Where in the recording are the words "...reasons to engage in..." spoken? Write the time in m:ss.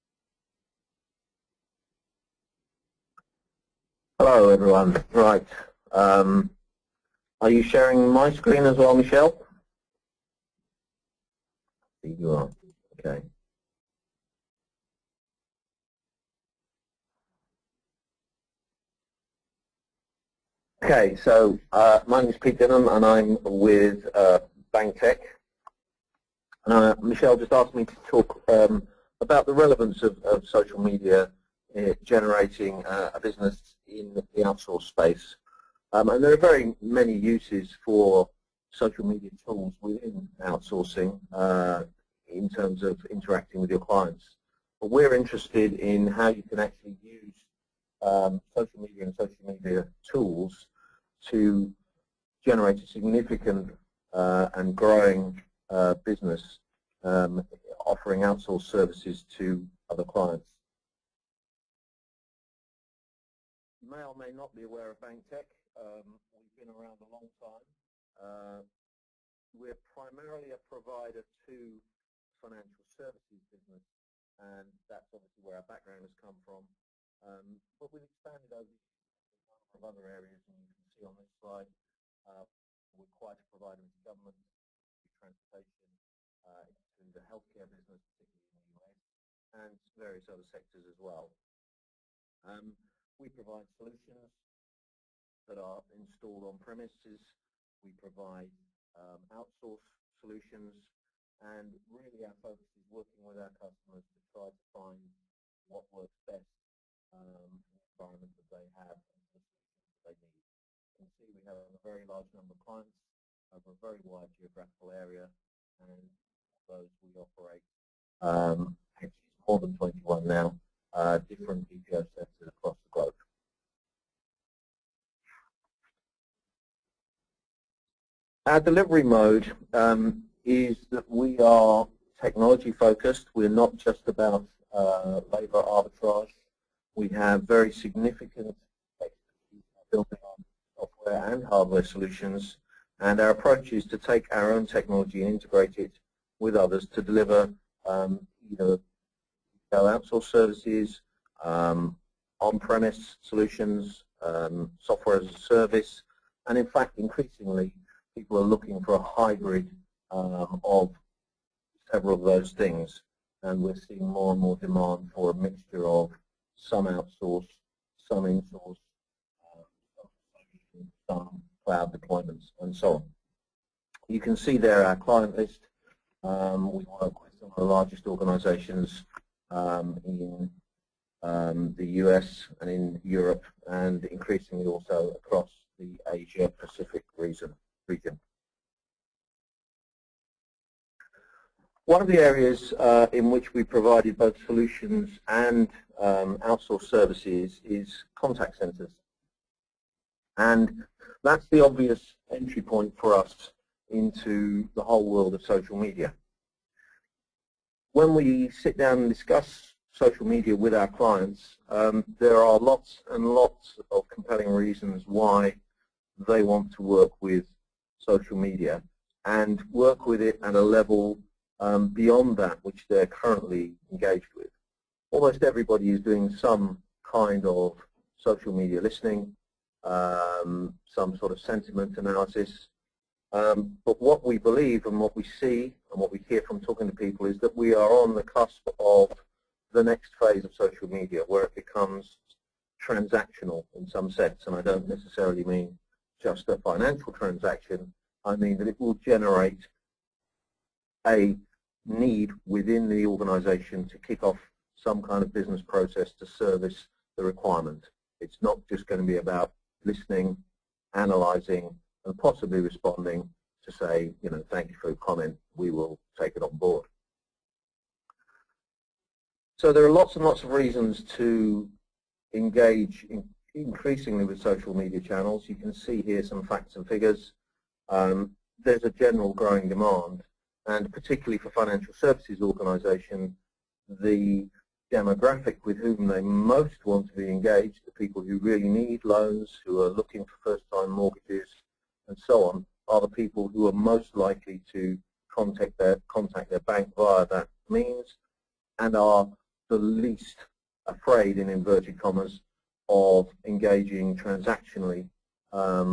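4:30.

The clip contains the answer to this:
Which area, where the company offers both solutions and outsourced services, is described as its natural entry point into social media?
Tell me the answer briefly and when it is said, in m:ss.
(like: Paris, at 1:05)
contact centers, at 3:18.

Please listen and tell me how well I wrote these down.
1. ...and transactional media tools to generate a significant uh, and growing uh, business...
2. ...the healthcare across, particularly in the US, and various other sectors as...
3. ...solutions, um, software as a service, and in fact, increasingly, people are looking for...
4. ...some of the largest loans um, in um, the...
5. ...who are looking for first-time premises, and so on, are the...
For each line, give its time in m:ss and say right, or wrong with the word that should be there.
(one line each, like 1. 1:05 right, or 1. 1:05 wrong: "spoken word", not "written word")
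1. 0:49 wrong: "social", not "transactional"
2. 1:27 wrong: "business", not "across"
3. 2:33 right
4. 2:57 wrong: "organizations", not "loans"
5. 4:49 wrong: "mortgages", not "premises".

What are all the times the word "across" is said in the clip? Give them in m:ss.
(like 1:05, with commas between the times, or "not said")
2:02, 3:05.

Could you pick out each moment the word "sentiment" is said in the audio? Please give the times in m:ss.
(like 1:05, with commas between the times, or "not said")
3:51.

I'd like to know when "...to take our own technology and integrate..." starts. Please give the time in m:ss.
2:23.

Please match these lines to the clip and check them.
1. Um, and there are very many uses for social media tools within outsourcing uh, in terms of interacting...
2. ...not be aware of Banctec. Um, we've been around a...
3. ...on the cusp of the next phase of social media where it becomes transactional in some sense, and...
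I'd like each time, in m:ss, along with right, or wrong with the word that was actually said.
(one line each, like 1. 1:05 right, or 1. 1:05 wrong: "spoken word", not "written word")
1. 0:35 right
2. 1:04 right
3. 3:58 right.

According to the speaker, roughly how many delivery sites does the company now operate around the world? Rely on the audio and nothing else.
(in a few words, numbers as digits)
more than 21.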